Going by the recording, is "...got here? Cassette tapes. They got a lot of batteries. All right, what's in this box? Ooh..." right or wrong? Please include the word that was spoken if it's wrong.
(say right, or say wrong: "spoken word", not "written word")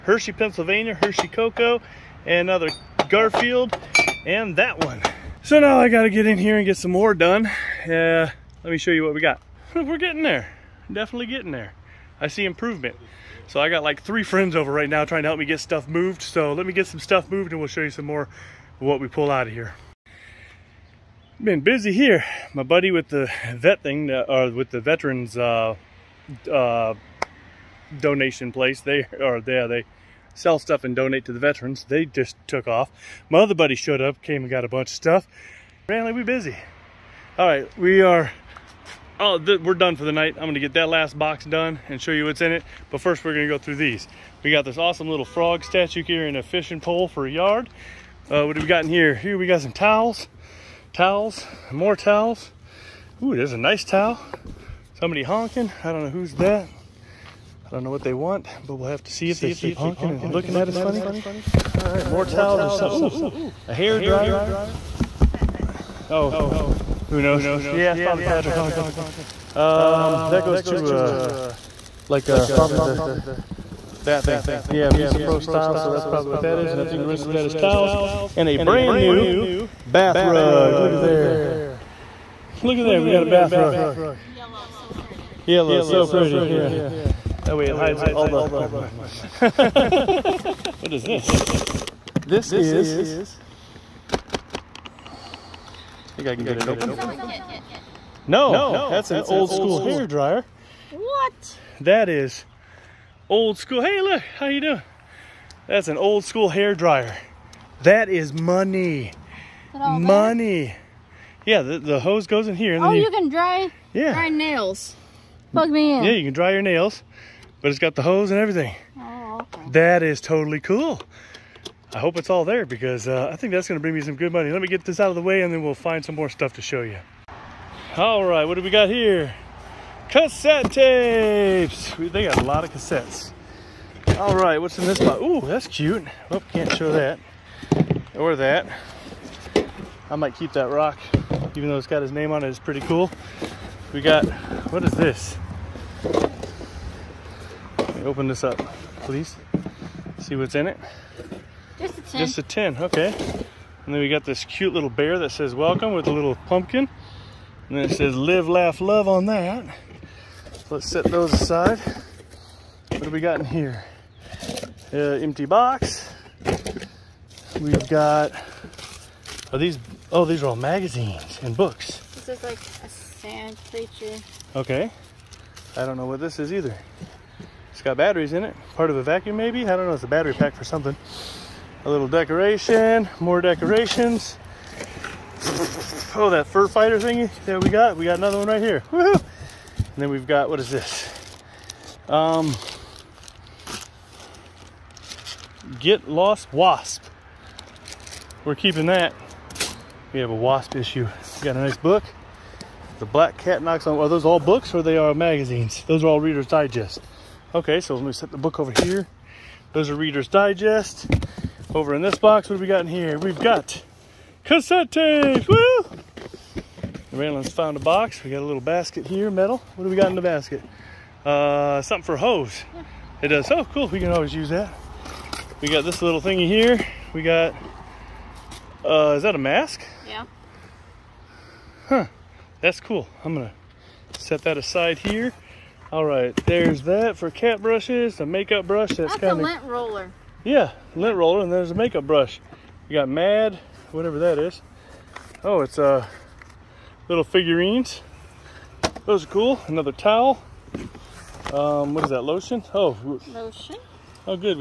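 wrong: "cassettes", not "batteries".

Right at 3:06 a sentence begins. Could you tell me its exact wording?
Oh, that fur fighter thingy that we got.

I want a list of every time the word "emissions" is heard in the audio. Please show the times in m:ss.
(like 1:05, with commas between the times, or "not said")
not said.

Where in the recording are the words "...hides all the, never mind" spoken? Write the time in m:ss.
1:27.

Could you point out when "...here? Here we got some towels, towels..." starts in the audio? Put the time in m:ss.
0:48.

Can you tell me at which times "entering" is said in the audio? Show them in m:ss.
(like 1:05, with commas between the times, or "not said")
not said.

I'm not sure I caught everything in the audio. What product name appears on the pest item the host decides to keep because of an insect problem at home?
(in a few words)
Get Lost Wasp.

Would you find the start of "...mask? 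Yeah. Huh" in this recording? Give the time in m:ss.
3:49.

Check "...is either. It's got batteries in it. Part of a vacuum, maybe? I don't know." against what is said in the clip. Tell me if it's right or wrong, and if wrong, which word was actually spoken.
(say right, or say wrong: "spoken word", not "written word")
right.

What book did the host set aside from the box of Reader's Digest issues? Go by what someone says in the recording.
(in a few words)
The Black Cat Knocks on.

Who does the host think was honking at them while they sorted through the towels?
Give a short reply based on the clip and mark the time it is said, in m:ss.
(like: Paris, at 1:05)
Patrick, at 1:08.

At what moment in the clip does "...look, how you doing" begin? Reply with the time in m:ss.
1:43.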